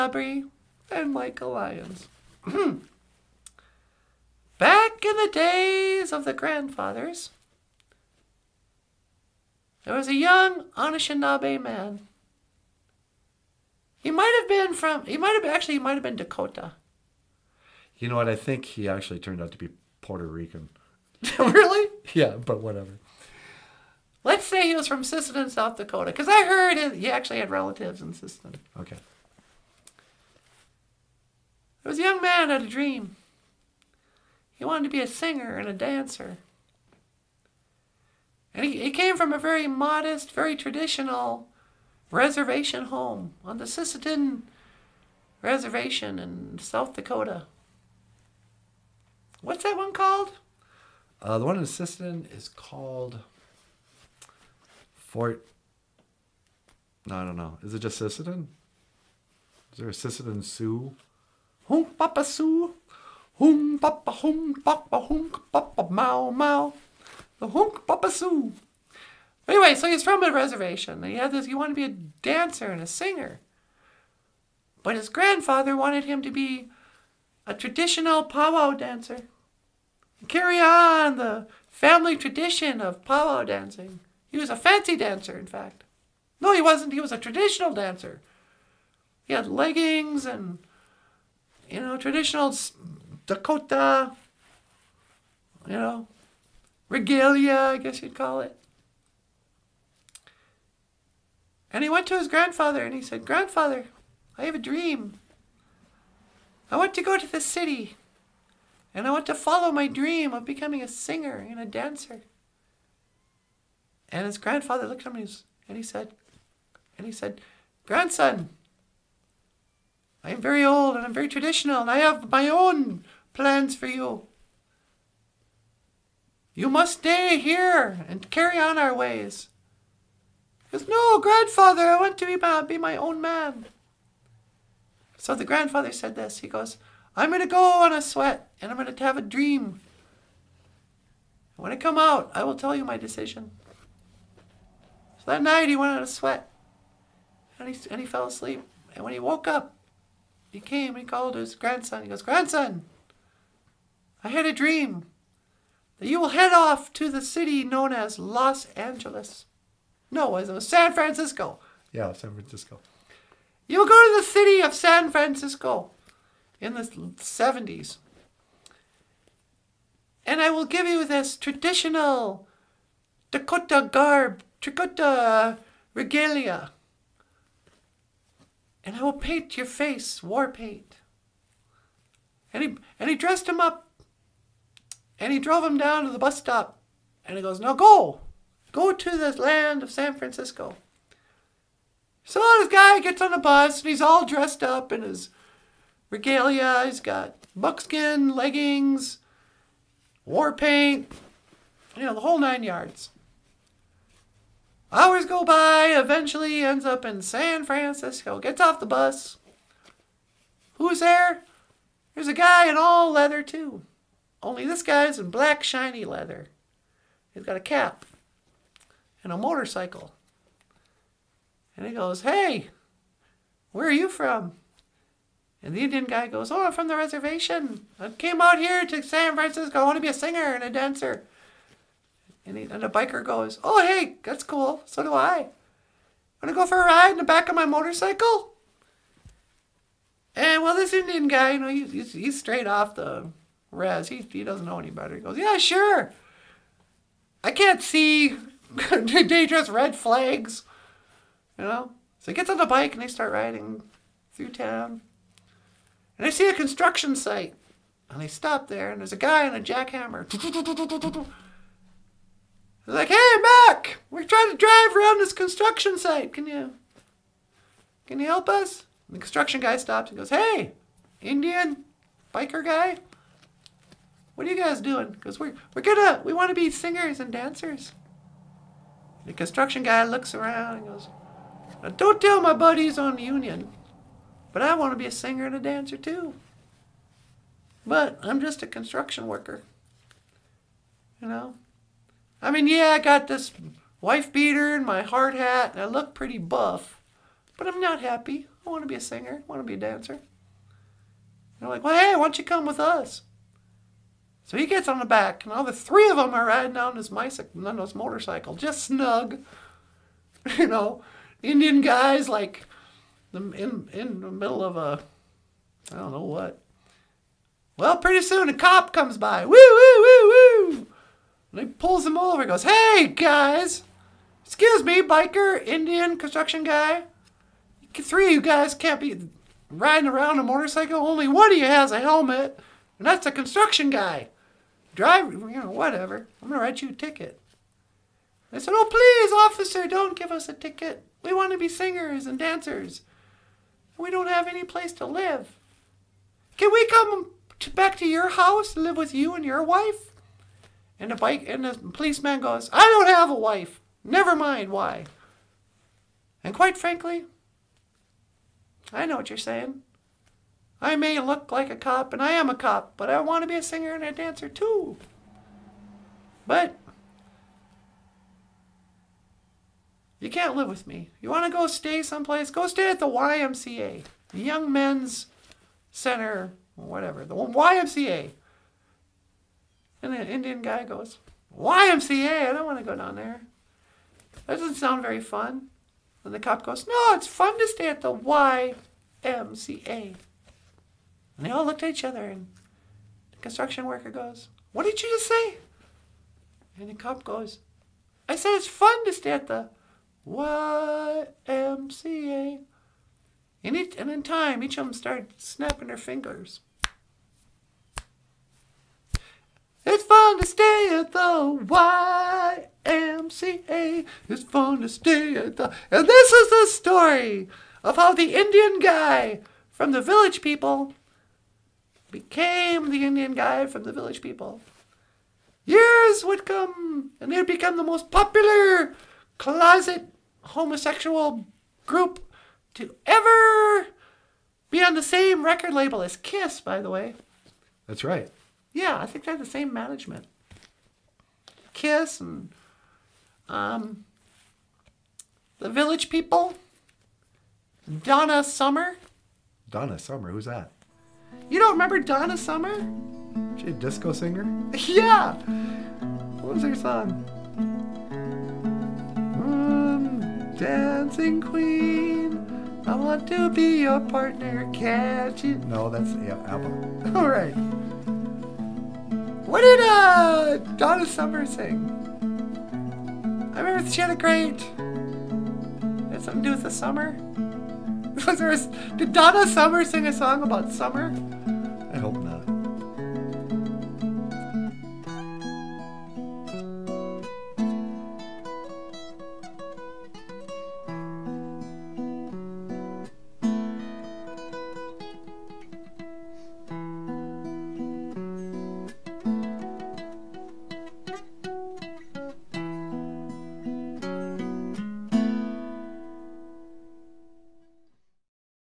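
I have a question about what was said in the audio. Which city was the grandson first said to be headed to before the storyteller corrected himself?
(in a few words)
Los Angeles.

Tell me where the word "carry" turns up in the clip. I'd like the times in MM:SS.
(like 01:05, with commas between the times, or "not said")
01:20, 02:08.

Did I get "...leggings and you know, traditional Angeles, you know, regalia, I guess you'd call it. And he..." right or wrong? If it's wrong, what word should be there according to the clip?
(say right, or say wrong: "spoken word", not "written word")
wrong: "Dakota", not "Angeles".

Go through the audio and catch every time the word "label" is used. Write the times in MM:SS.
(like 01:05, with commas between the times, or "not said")
07:15.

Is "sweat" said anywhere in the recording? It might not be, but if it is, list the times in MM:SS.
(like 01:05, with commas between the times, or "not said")
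02:18, 02:26.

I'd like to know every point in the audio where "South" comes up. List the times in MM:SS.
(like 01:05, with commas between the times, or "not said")
00:25, 00:46.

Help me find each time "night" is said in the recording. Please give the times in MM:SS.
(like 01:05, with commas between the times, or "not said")
02:25.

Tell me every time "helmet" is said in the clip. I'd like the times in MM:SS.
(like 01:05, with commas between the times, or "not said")
05:32.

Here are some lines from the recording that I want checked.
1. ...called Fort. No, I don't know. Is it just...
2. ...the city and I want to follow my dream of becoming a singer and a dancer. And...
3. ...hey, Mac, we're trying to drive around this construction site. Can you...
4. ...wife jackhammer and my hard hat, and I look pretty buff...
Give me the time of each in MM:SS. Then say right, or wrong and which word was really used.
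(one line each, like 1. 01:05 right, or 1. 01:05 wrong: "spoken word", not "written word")
1. 00:52 right
2. 01:47 right
3. 04:23 right
4. 04:54 wrong: "beater", not "jackhammer".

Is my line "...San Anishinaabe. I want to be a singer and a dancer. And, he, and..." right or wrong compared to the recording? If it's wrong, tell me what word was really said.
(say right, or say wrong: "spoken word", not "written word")
wrong: "Francisco", not "Anishinaabe".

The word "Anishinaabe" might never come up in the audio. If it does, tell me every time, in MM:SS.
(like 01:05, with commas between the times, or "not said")
00:10.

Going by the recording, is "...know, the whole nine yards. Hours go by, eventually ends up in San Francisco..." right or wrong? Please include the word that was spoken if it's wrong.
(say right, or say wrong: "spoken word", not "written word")
right.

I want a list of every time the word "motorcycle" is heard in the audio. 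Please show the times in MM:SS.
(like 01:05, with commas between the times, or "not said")
03:39, 03:57, 05:07, 05:30.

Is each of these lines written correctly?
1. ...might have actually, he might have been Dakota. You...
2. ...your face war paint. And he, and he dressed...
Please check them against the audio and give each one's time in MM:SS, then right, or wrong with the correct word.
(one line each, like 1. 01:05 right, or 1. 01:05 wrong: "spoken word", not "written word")
1. 00:15 right
2. 02:59 right.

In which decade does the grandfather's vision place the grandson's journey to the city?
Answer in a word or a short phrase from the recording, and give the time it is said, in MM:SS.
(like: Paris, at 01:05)
The 70s, at 02:46.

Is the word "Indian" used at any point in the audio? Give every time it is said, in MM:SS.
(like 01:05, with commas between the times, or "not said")
03:45, 04:00, 04:31, 05:11, 05:25, 06:20, 06:58, 07:03.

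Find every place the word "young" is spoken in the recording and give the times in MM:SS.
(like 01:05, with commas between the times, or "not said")
00:10, 00:32, 06:14.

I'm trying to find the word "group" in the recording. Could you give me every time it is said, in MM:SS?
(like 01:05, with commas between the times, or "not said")
07:11.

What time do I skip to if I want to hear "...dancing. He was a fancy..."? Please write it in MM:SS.
01:23.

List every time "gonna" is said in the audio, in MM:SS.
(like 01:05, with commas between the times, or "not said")
04:35, 05:36.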